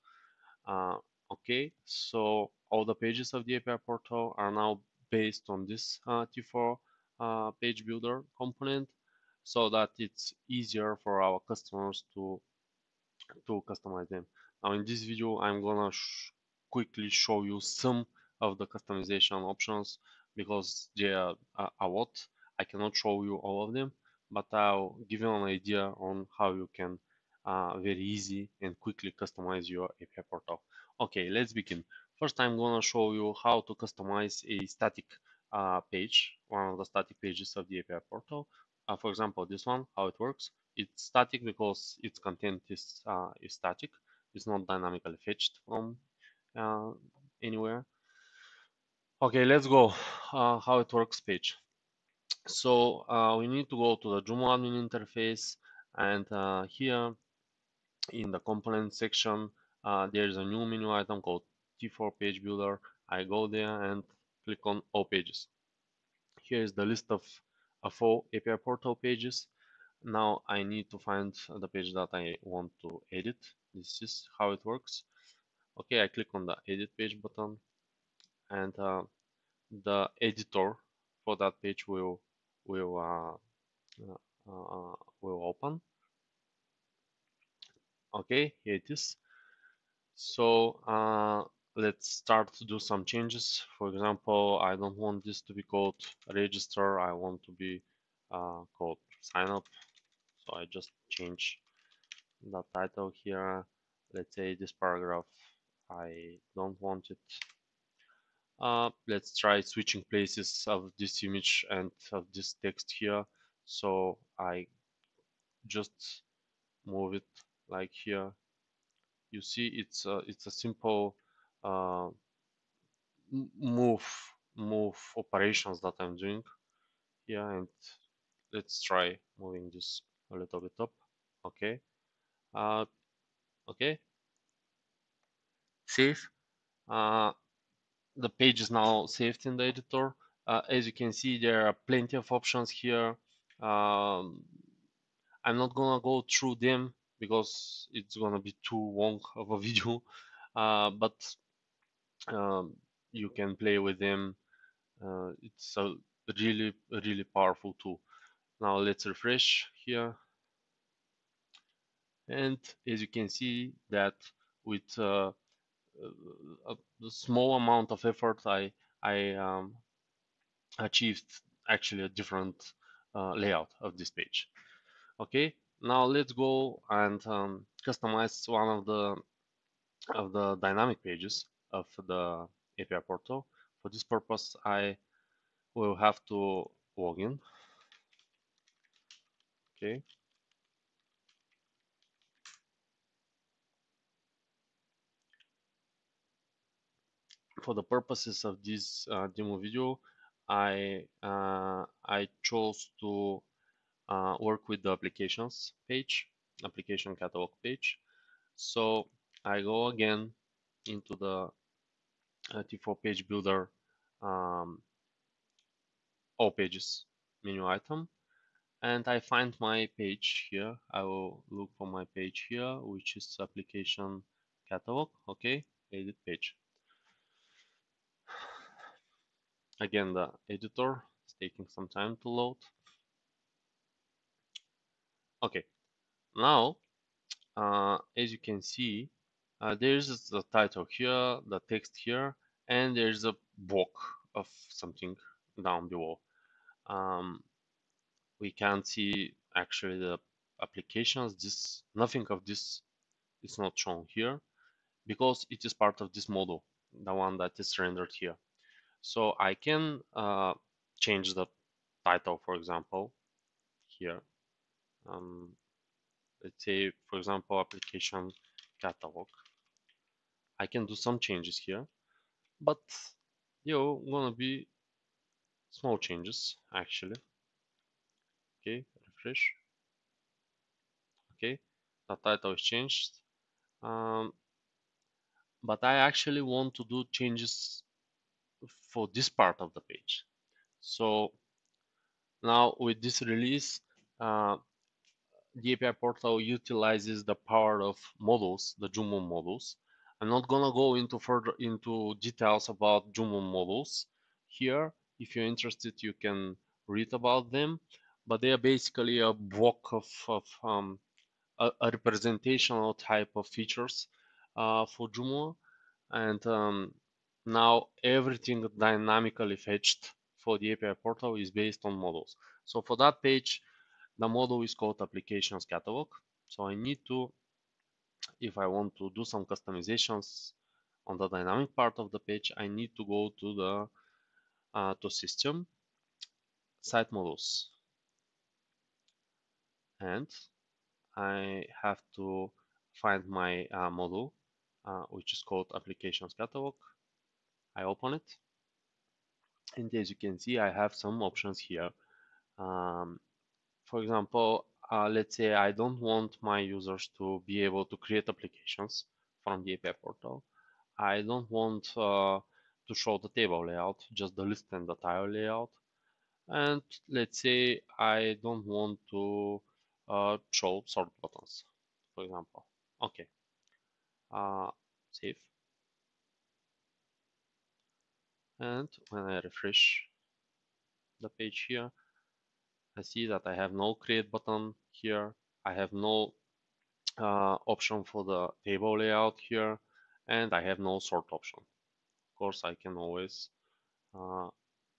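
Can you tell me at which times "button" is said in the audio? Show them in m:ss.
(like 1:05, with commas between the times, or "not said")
1:17, 6:11, 6:24.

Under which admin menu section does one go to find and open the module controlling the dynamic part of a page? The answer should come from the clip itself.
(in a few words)
site modules.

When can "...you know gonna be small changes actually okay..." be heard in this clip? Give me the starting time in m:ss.
4:33.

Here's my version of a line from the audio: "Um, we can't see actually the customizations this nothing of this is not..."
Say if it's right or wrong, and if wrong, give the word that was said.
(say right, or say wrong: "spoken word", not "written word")
wrong: "applications", not "customizations".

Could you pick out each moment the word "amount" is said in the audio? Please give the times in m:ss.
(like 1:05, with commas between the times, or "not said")
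2:47.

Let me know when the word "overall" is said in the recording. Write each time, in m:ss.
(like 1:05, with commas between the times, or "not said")
not said.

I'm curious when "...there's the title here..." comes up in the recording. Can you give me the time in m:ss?
3:59.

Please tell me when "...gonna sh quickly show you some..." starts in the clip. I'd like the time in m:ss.
0:15.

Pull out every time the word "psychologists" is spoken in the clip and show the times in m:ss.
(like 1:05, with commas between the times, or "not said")
not said.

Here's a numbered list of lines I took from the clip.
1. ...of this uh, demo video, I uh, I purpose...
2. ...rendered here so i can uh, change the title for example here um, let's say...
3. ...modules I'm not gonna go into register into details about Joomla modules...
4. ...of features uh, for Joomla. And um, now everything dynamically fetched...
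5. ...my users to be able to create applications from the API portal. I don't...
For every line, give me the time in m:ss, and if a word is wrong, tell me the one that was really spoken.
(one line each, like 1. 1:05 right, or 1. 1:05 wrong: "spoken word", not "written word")
1. 3:18 wrong: "chose", not "purpose"
2. 4:17 right
3. 4:59 wrong: "further", not "register"
4. 5:13 right
5. 5:56 right.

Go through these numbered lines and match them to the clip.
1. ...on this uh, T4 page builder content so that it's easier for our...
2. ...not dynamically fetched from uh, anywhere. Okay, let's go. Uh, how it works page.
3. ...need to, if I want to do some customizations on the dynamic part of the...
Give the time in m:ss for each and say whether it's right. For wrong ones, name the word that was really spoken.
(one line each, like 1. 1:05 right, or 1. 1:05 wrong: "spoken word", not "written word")
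1. 0:05 wrong: "component", not "content"
2. 0:44 right
3. 5:26 right.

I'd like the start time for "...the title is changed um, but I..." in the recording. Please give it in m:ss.
4:42.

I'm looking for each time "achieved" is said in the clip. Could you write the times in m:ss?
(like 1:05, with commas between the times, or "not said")
2:50.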